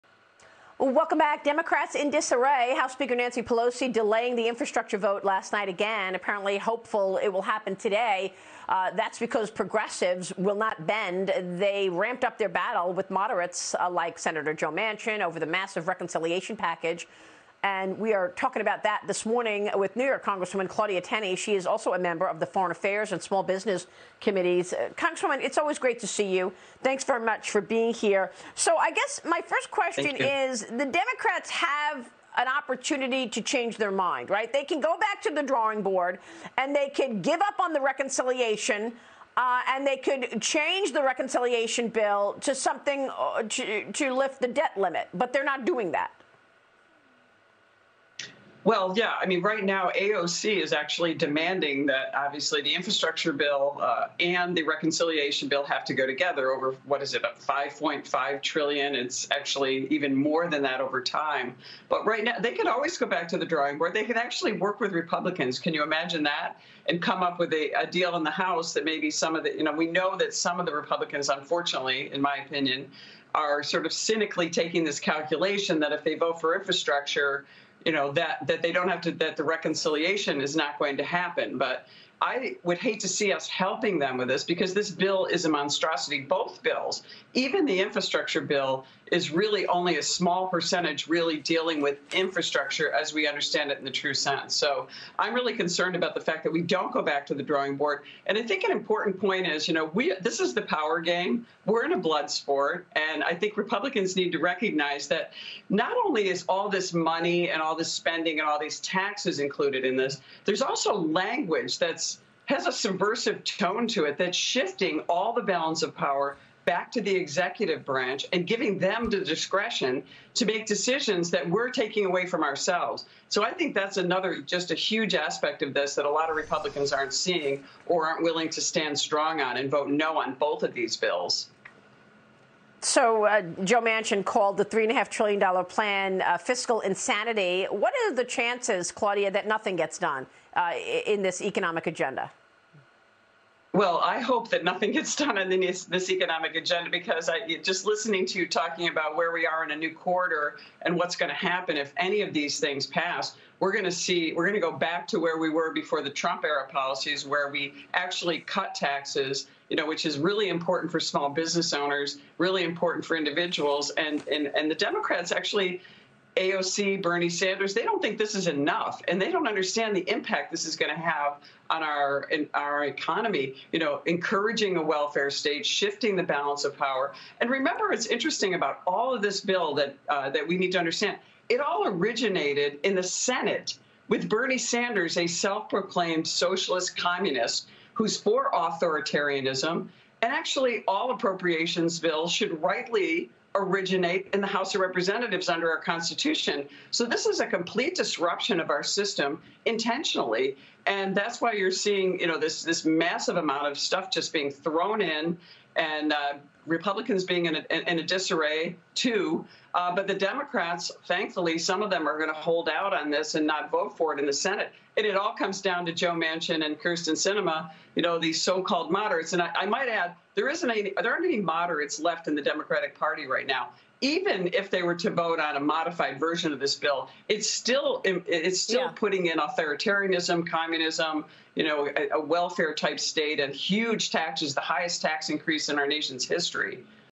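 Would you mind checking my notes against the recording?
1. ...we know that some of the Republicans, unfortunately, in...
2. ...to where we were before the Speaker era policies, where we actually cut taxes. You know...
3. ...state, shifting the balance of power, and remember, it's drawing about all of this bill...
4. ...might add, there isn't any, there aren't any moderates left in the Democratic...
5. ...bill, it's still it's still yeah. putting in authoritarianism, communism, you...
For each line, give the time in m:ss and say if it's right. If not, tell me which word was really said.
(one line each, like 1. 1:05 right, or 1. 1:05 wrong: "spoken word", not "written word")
1. 1:09 right
2. 2:35 wrong: "Trump", not "Speaker"
3. 2:55 wrong: "interesting", not "drawing"
4. 3:39 right
5. 3:46 right.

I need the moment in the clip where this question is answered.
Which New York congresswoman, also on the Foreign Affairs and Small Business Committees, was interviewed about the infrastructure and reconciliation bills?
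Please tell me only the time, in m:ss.
0:20.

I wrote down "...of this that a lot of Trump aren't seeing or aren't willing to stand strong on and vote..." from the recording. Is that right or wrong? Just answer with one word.
wrong.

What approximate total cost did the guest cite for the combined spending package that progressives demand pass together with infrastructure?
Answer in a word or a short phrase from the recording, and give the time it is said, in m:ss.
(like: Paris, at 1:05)
5.5 trillion, at 0:57.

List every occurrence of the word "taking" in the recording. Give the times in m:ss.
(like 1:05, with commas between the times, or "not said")
1:14, 2:01.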